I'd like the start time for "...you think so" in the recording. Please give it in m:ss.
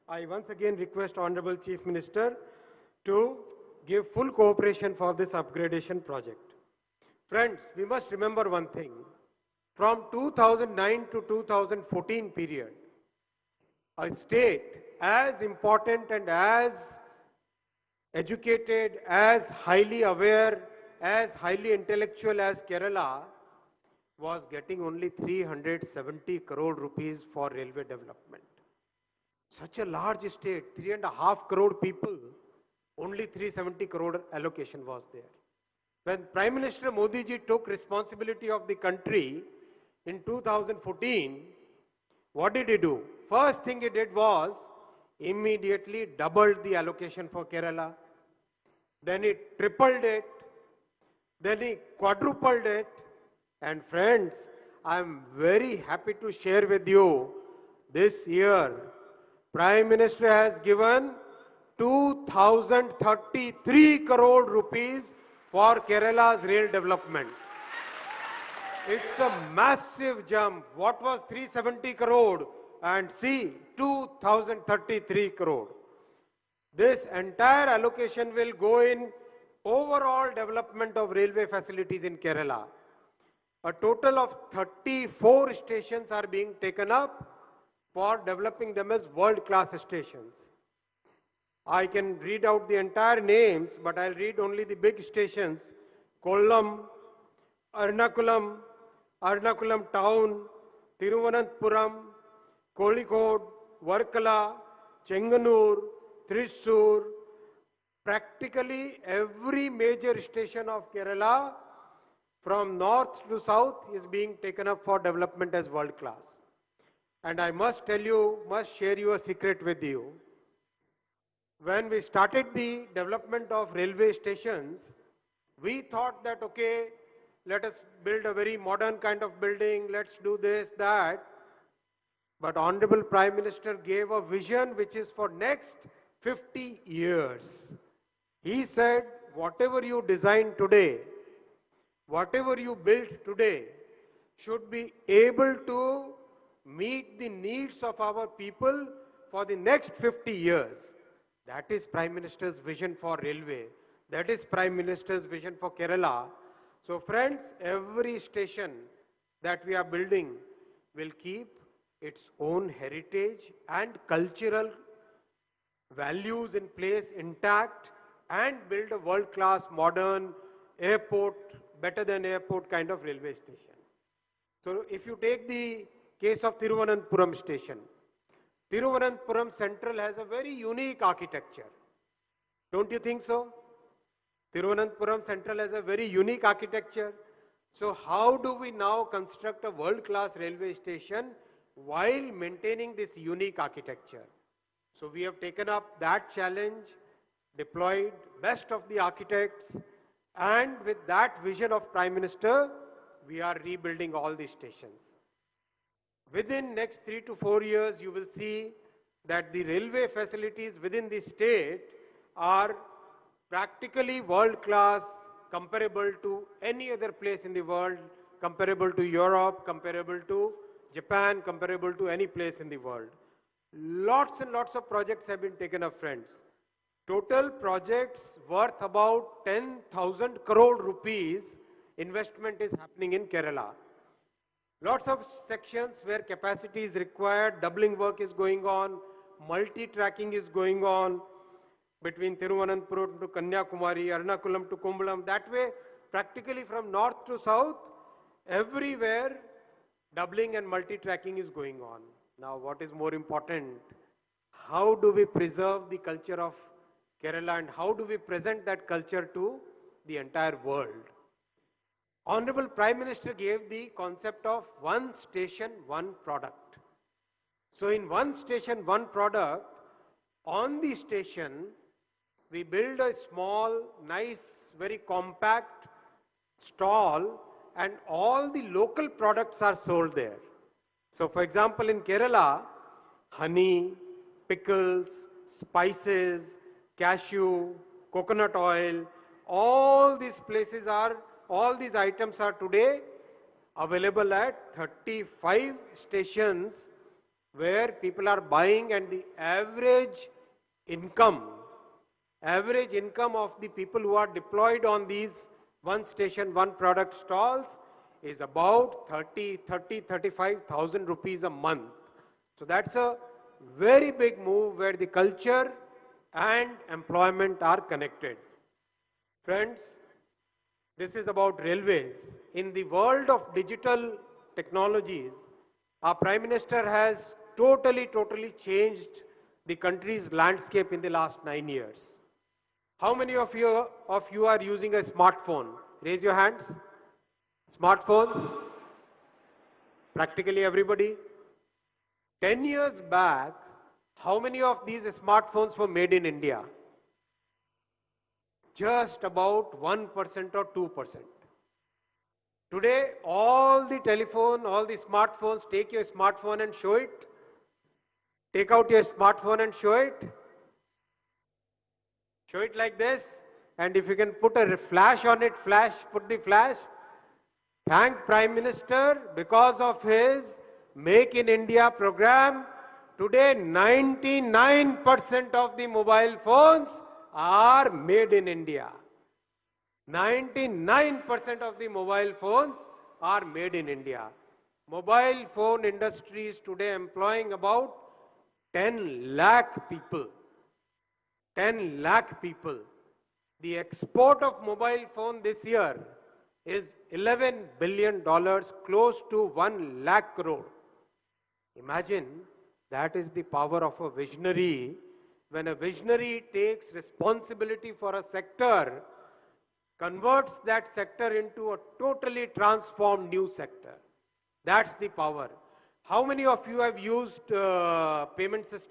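3:02.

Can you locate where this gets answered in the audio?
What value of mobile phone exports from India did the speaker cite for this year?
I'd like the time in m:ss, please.
6:37.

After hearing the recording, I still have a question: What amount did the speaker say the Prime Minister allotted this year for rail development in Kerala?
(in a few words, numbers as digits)
2,033 crore rupees.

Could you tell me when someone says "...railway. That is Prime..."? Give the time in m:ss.
2:33.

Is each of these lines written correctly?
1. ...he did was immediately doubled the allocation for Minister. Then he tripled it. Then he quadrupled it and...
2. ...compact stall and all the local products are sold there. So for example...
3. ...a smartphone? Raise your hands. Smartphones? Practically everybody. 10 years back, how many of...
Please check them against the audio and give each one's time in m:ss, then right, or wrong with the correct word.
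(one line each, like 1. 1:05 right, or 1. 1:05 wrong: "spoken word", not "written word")
1. 0:43 wrong: "Kerala", not "Minister"
2. 4:34 right
3. 5:34 right.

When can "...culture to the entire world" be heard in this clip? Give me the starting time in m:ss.
4:18.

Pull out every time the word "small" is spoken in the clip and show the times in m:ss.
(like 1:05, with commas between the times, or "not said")
4:33.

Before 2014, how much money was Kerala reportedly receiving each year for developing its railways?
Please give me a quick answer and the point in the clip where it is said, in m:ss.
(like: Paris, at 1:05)
370 crore rupees, at 0:25.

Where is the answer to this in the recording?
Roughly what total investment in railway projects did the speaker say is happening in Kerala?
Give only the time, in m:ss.
3:49.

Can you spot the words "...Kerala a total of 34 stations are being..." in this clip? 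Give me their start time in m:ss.
1:22.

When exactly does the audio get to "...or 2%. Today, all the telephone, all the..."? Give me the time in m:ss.
5:50.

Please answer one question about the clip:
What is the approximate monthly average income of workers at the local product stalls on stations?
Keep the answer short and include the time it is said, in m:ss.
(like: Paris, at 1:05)
35,000 rupees, at 5:10.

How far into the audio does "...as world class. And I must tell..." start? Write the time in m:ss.
1:55.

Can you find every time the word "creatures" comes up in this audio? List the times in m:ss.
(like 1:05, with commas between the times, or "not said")
not said.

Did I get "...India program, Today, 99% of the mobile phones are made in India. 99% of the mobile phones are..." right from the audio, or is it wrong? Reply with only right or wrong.
right.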